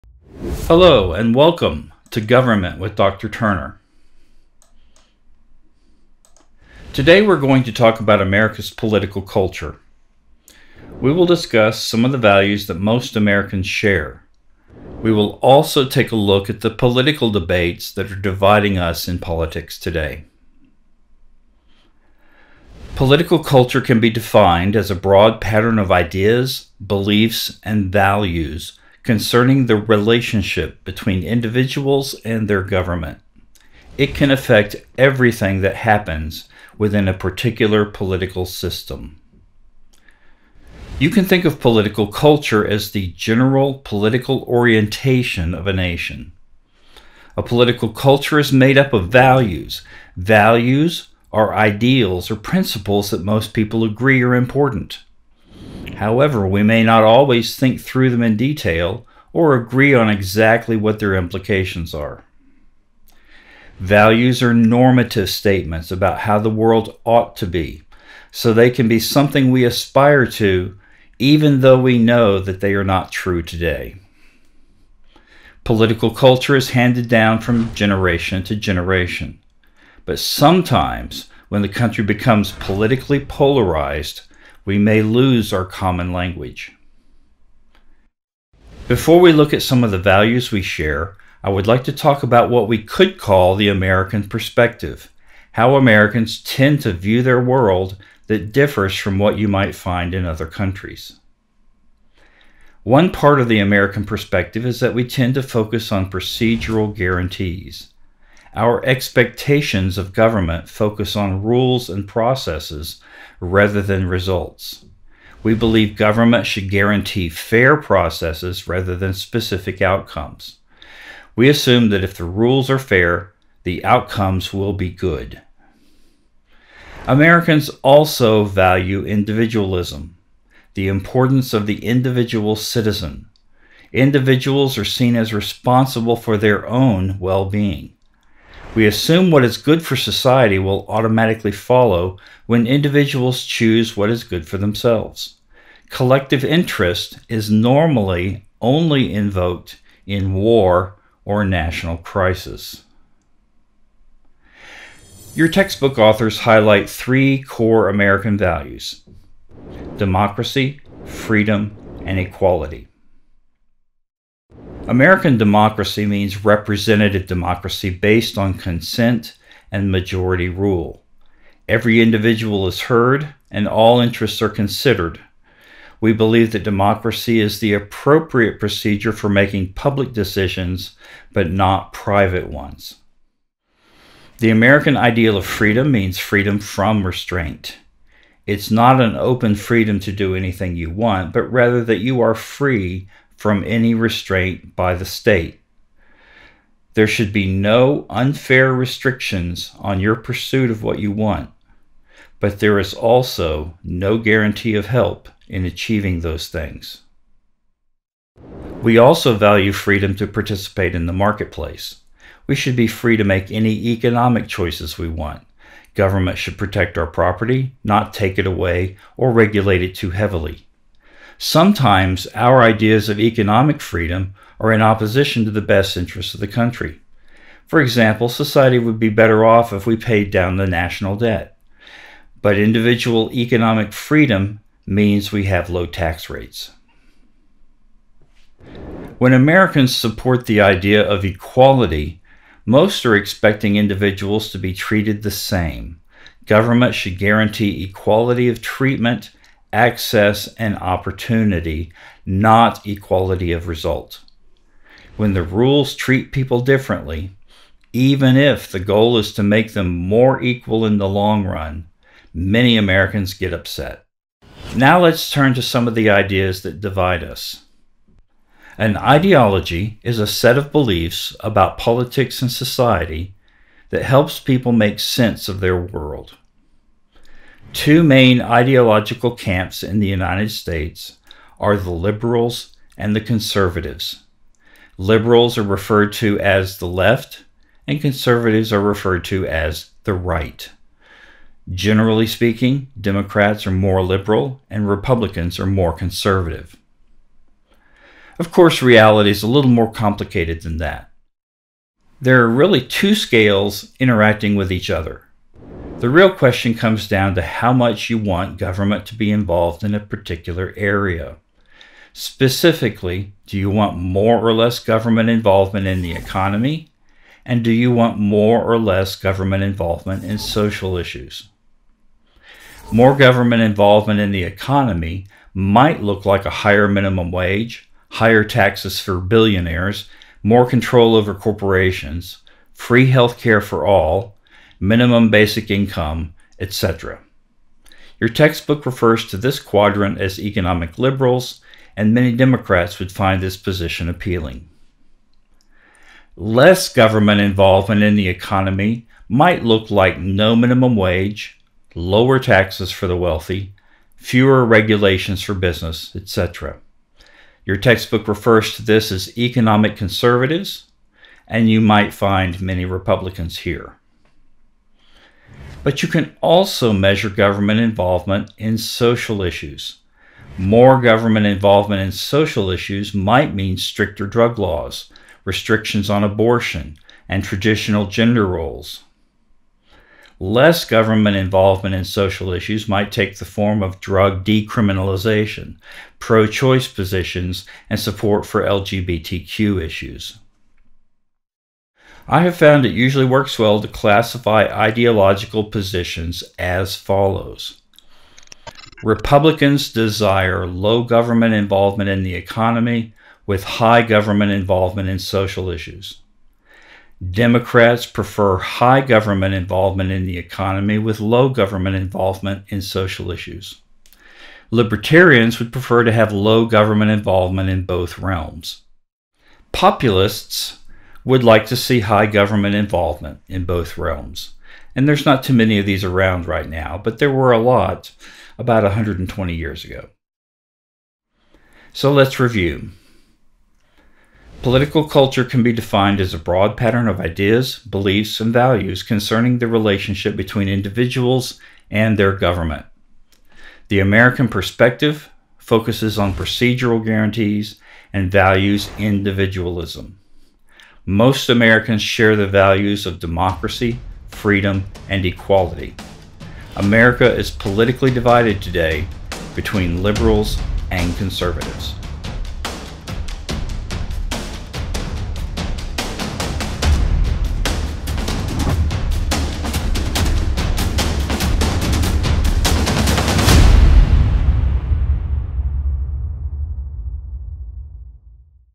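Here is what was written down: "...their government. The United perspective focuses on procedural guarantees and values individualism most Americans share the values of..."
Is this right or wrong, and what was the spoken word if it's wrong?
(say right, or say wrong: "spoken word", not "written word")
wrong: "American", not "United".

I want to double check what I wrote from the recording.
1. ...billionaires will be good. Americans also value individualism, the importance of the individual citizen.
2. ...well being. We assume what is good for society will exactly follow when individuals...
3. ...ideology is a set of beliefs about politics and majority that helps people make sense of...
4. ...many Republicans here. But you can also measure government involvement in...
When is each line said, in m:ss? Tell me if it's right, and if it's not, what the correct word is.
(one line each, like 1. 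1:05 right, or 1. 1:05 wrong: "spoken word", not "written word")
1. 2:03 wrong: "outcomes", not "billionaires"
2. 2:17 wrong: "automatically", not "exactly"
3. 4:28 wrong: "society", not "majority"
4. 6:02 right.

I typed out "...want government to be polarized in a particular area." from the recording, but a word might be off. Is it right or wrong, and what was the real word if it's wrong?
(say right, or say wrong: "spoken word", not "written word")
wrong: "involved", not "polarized".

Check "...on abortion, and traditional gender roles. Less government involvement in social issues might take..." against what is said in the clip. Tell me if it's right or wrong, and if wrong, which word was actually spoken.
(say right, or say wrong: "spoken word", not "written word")
right.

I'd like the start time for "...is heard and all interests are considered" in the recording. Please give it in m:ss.
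2:52.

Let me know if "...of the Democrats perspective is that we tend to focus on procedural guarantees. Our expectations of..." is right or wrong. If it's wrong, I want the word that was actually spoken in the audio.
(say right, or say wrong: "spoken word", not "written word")
wrong: "American", not "Democrats".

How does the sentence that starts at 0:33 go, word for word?
It can affect everything that happens within a particular political system.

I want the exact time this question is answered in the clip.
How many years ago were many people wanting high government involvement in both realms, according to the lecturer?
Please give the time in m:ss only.
7:08.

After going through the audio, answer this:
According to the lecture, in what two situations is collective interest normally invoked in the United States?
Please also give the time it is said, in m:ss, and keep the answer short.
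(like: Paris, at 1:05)
War or national crisis, at 2:30.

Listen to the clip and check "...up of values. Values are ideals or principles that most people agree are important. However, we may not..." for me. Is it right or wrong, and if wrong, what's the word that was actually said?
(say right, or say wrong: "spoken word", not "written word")
right.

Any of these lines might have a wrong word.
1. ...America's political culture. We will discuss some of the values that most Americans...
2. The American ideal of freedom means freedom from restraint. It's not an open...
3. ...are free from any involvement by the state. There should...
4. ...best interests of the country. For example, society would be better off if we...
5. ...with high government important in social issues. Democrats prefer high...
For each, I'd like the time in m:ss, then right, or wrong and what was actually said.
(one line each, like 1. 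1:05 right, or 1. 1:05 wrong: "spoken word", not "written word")
1. 0:08 right
2. 3:04 right
3. 3:12 wrong: "restraint", not "involvement"
4. 3:45 right
5. 6:43 wrong: "involvement", not "important".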